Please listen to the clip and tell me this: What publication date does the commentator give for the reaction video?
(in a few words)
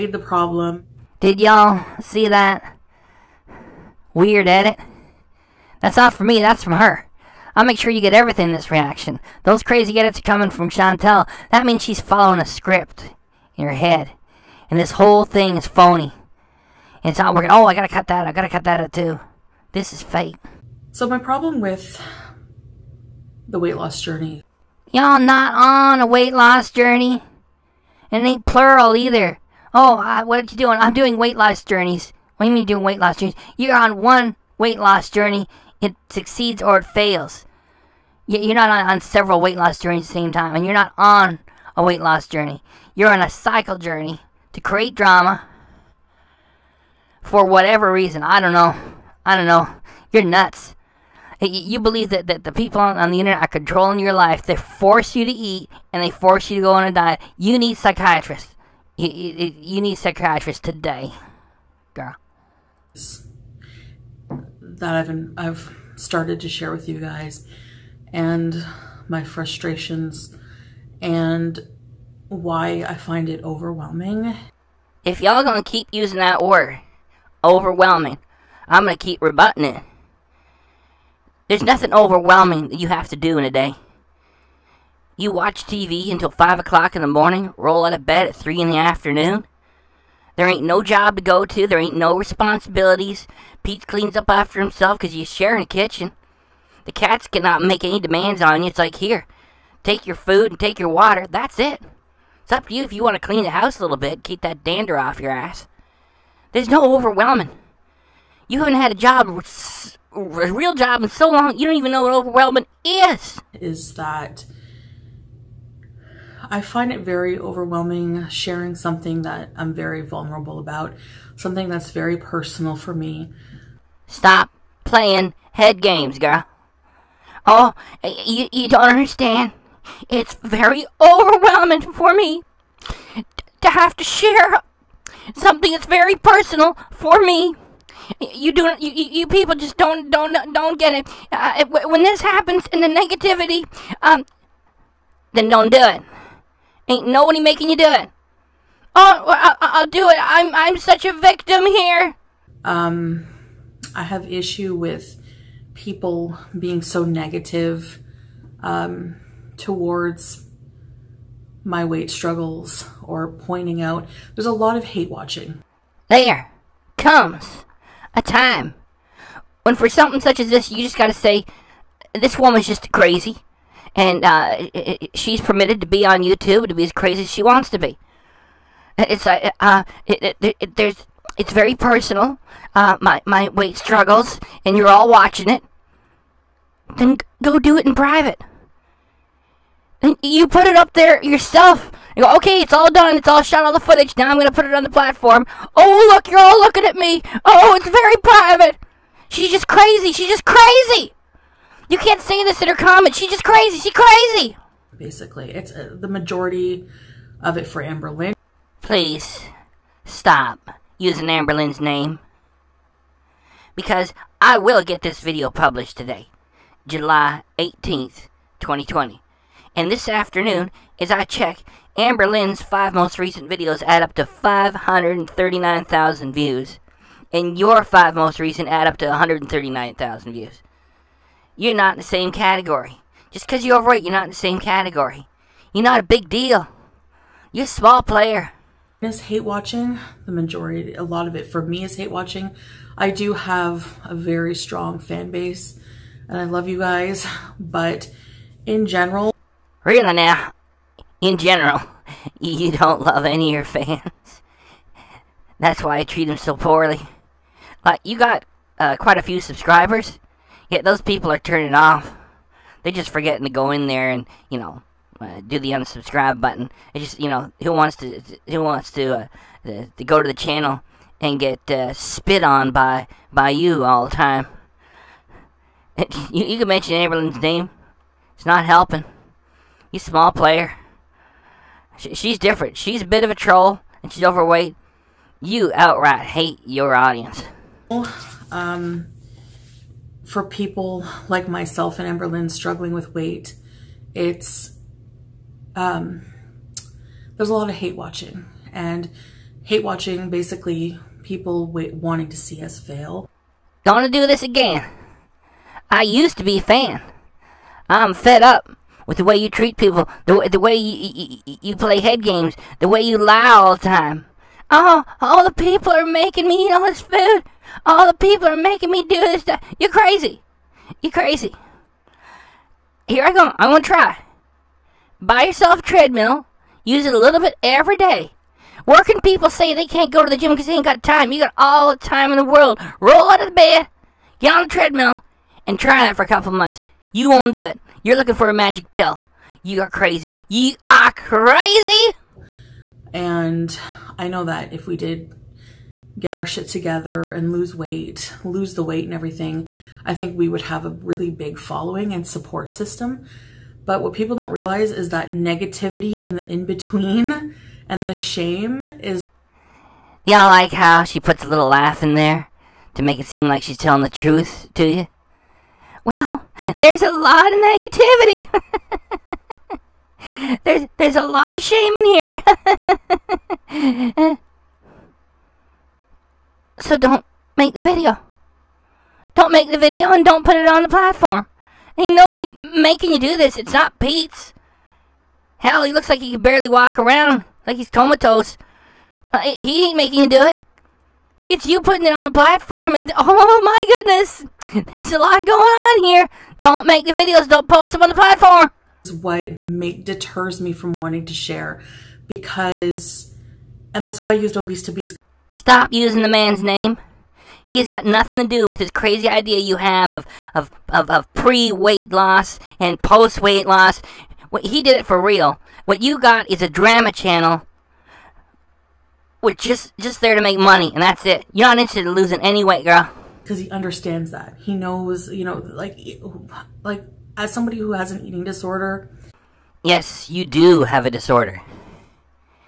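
July 18th, 2020.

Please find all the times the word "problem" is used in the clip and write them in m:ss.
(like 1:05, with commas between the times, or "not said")
0:00, 0:21.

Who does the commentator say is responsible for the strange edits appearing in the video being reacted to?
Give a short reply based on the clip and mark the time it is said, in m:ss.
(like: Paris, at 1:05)
Chantel, at 0:10.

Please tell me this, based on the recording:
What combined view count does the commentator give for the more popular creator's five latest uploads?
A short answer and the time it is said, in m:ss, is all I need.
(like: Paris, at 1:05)
539,000, at 3:44.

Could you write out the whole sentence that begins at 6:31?
It's you putting it on the platform.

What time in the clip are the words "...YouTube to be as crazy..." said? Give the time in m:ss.
2:56.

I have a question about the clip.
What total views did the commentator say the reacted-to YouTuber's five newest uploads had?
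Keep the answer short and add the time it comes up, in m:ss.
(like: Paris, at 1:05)
139,000, at 3:49.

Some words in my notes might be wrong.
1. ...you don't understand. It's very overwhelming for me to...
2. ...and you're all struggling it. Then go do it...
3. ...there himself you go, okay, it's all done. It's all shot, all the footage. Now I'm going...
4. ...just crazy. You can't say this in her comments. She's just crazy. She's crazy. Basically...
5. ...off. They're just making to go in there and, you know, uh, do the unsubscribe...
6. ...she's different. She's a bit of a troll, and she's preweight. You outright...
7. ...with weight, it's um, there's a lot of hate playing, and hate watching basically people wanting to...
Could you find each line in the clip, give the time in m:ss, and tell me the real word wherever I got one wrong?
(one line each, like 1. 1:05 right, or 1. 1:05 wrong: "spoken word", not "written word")
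1. 2:08 right
2. 3:04 wrong: "watching", not "struggling"
3. 3:10 wrong: "yourself", not "himself"
4. 3:20 right
5. 4:21 wrong: "forgetting", not "making"
6. 4:42 wrong: "overweight", not "preweight"
7. 4:52 wrong: "watching", not "playing".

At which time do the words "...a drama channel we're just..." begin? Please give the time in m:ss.
6:56.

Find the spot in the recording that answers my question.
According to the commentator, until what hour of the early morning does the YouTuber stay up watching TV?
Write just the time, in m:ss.
1:26.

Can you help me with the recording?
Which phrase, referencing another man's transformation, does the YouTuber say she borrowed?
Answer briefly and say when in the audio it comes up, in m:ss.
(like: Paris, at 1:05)
obese to beast, at 6:44.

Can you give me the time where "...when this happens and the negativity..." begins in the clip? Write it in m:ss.
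2:21.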